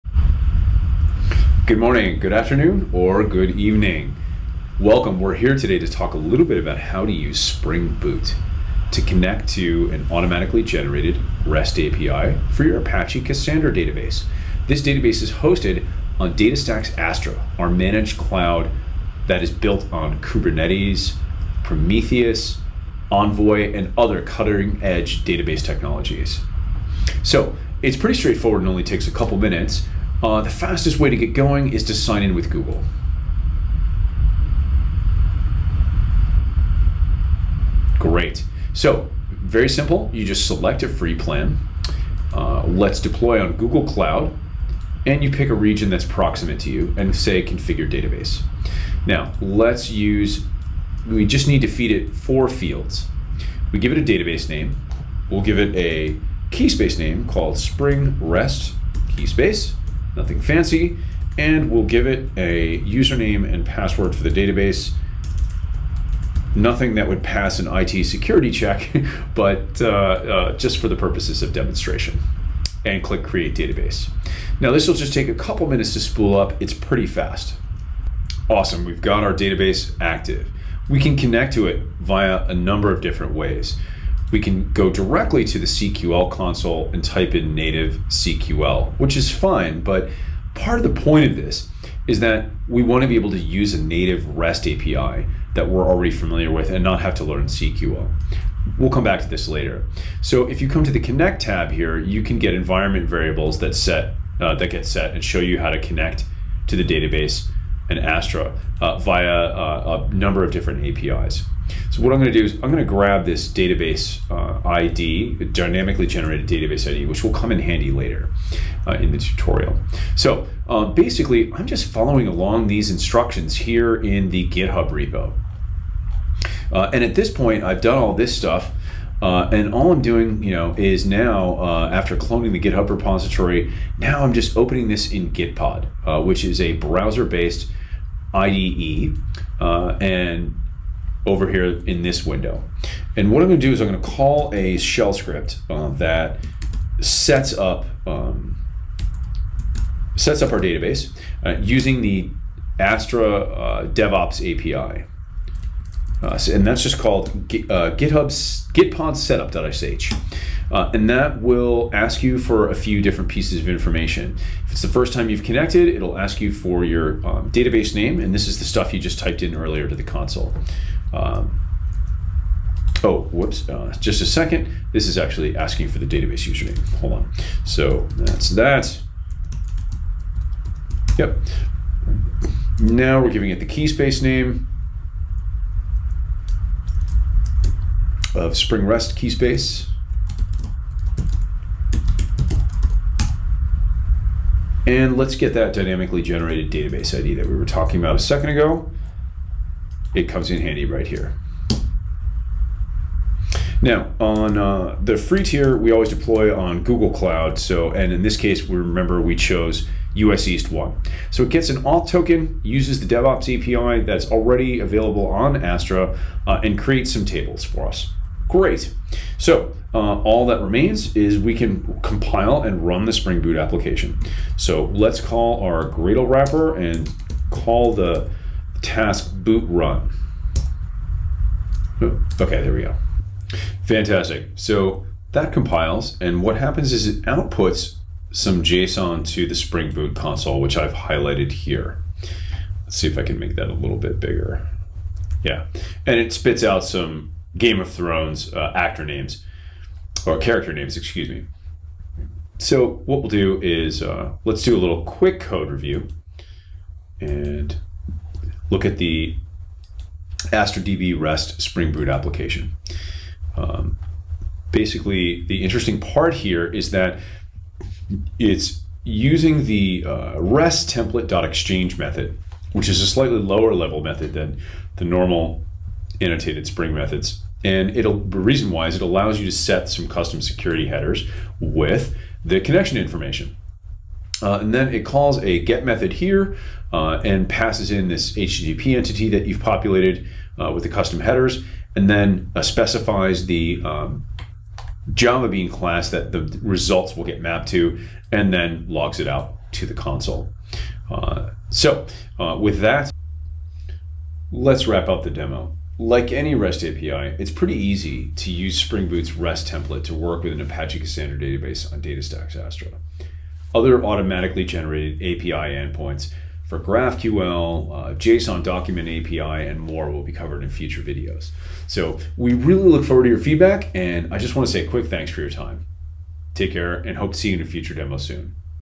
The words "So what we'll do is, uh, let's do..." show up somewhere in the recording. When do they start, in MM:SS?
04:12.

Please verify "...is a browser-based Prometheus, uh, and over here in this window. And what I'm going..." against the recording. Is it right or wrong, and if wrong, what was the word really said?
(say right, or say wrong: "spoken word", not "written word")
wrong: "IDE", not "Prometheus".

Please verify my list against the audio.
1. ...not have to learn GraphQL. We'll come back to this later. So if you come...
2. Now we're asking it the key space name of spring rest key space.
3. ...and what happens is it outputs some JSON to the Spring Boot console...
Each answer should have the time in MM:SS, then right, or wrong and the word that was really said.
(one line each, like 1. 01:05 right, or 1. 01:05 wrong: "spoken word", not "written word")
1. 01:36 wrong: "CQL", not "GraphQL"
2. 03:02 wrong: "giving", not "asking"
3. 03:56 right.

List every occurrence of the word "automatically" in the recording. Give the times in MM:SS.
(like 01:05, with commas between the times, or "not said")
00:10, 05:14.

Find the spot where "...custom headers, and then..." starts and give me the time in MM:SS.
04:50.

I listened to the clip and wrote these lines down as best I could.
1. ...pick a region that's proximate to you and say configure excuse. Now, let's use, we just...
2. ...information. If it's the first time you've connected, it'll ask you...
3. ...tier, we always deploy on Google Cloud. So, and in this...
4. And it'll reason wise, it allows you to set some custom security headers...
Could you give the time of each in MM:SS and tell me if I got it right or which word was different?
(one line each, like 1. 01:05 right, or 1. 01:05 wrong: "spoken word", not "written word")
1. 00:45 wrong: "database", not "excuse"
2. 02:43 right
3. 03:25 right
4. 04:37 right.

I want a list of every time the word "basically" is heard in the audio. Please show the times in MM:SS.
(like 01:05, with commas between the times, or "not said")
02:00, 04:24.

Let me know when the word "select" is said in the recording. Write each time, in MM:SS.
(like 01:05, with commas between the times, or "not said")
00:40.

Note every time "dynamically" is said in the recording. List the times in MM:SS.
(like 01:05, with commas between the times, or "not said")
01:55, 03:15.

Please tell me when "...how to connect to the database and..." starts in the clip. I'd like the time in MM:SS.
01:45.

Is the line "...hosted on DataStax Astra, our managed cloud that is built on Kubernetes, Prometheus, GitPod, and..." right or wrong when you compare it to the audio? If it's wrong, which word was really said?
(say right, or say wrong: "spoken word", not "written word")
wrong: "Envoy", not "GitPod".